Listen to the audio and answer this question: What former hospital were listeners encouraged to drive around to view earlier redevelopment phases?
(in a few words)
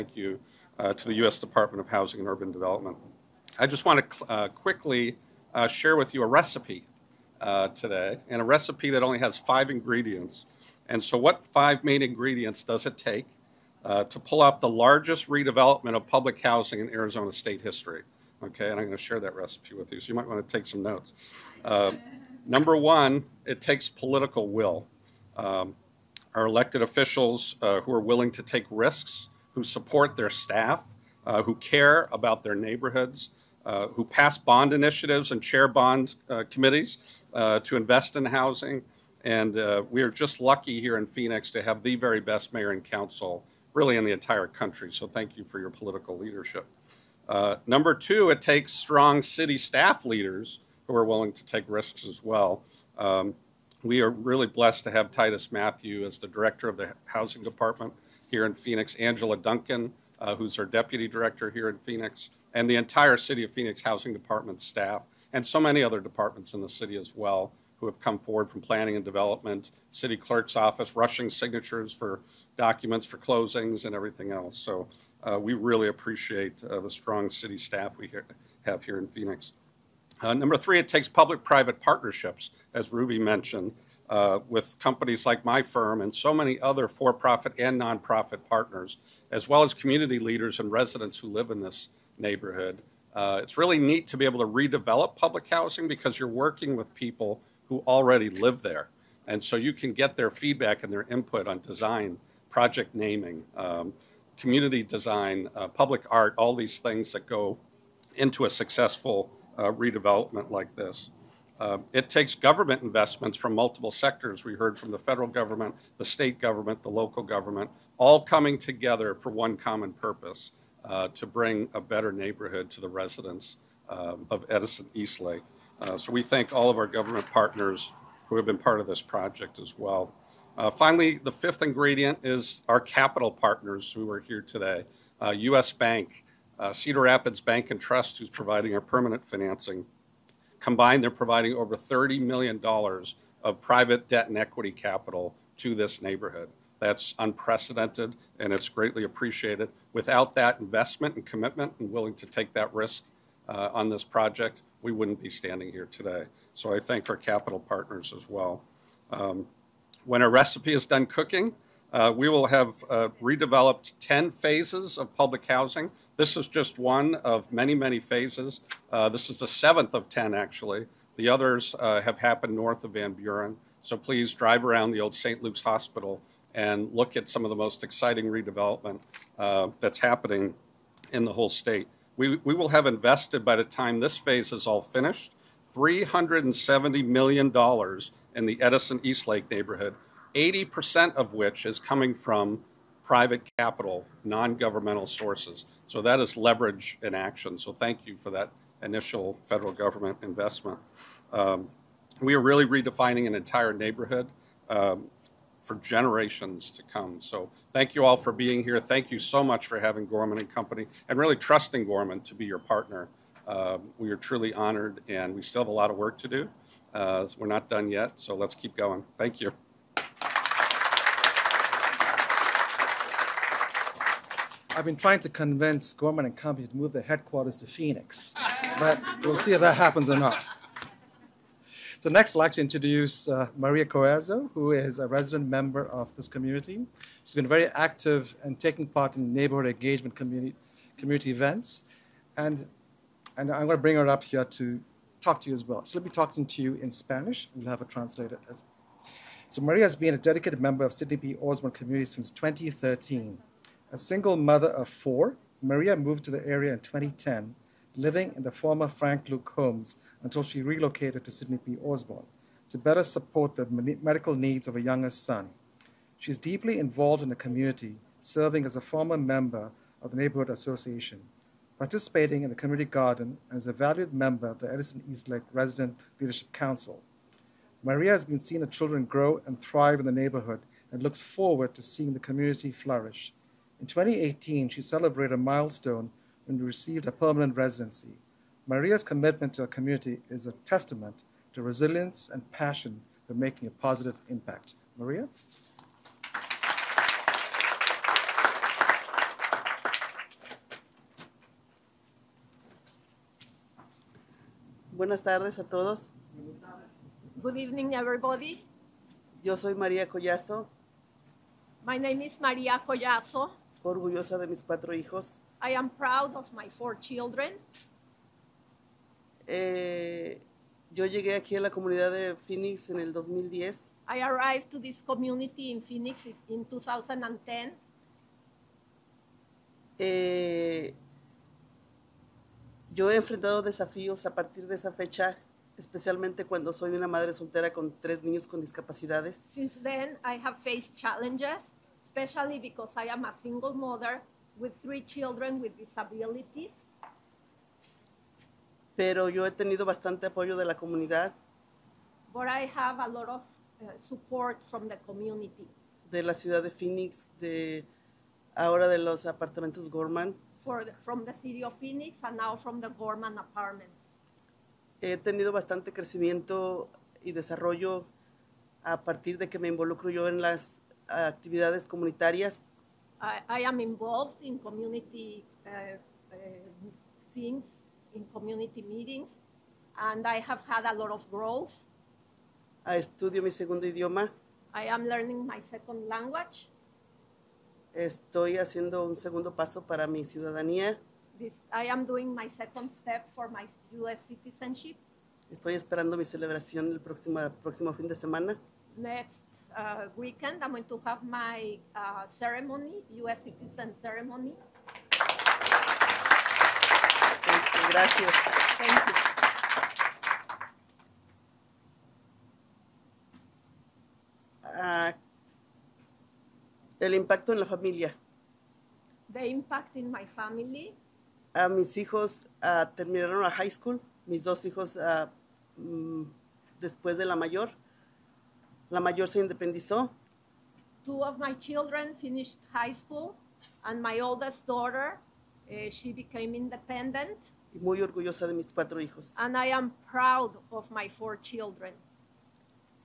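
St. Luke's Hospital.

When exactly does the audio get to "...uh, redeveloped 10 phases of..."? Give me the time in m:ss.
2:42.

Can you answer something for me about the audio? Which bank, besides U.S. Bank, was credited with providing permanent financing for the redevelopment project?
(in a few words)
Cedar Rapids Bank and Trust.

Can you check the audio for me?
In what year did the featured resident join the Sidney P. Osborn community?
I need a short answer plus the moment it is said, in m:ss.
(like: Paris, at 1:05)
2013, at 4:12.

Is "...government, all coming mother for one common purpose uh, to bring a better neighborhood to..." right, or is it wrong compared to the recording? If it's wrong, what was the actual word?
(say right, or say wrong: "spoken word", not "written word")
wrong: "together", not "mother".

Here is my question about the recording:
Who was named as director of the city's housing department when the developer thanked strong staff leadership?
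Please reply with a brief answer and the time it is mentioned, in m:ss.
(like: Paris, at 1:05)
Titus Matthew, at 0:55.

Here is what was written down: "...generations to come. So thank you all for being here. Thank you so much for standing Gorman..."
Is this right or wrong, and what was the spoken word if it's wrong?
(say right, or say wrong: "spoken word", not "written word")
wrong: "having", not "standing".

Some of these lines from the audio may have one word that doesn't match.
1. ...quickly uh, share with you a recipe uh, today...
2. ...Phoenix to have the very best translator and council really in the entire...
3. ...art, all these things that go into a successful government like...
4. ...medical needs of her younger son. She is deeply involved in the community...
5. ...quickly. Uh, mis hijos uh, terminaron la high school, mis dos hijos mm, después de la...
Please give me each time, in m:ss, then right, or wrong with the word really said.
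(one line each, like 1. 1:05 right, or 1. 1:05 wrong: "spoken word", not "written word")
1. 0:04 right
2. 0:41 wrong: "mayor", not "translator"
3. 1:46 wrong: "redevelopment", not "government"
4. 4:24 right
5. 7:00 wrong: "family", not "quickly".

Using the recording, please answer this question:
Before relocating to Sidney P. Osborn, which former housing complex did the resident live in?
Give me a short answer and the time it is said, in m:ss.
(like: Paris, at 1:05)
Frank Luke Homes, at 4:18.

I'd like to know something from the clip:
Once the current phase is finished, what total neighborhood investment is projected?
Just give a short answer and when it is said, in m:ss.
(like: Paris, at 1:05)
$370 million, at 3:05.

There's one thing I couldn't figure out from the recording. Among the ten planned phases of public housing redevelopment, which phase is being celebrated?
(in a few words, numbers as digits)
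7th.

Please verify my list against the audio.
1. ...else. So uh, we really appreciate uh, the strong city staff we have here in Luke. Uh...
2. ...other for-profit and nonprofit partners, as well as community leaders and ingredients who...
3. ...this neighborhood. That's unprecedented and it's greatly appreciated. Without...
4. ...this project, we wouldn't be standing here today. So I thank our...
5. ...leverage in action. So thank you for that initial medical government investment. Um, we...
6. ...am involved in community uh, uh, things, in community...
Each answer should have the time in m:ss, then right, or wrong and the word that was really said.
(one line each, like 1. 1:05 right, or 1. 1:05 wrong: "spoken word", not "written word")
1. 1:14 wrong: "Phoenix", not "Luke"
2. 1:26 wrong: "residents", not "ingredients"
3. 2:25 right
4. 2:33 right
5. 3:16 wrong: "federal", not "medical"
6. 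6:13 right.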